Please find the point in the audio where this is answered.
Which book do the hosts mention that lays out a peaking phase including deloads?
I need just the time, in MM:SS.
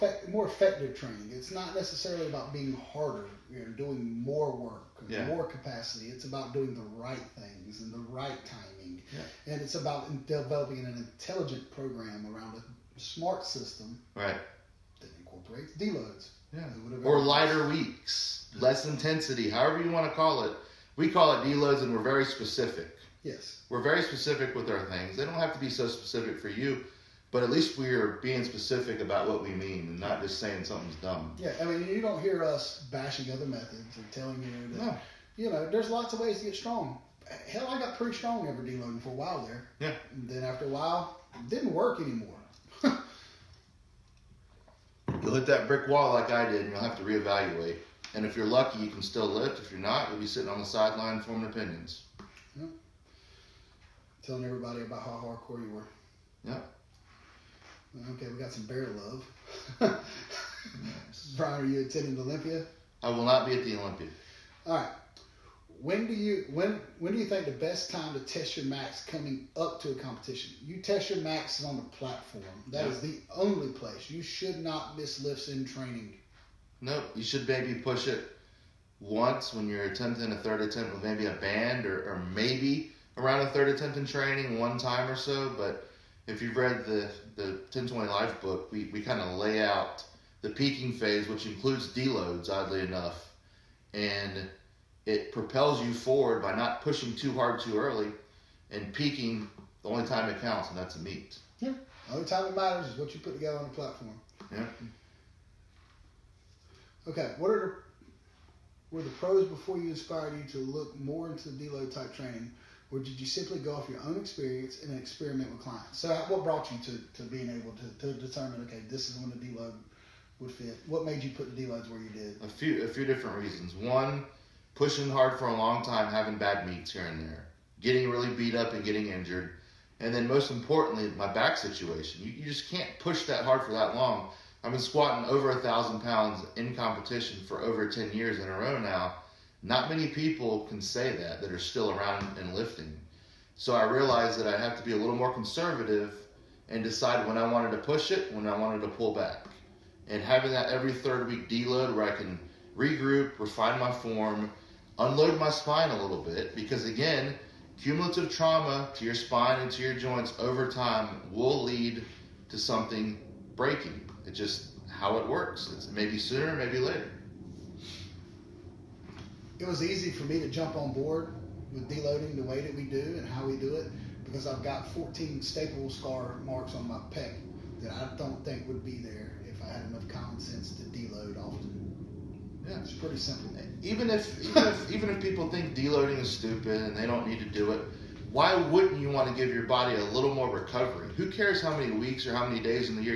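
01:27.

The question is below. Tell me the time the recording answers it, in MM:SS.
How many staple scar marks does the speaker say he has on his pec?
02:54.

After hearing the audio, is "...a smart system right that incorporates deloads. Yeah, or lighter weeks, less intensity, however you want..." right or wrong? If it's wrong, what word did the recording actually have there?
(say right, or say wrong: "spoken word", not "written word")
right.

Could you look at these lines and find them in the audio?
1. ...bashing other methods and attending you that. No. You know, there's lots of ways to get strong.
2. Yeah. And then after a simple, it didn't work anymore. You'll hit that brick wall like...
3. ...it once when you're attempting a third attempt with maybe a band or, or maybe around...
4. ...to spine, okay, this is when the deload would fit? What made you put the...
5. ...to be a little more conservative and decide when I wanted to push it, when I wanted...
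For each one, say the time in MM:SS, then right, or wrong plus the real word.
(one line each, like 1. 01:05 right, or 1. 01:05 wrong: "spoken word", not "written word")
1. 00:32 wrong: "telling", not "attending"
2. 00:39 wrong: "while", not "simple"
3. 01:18 right
4. 01:58 wrong: "determine", not "spine"
5. 02:24 right.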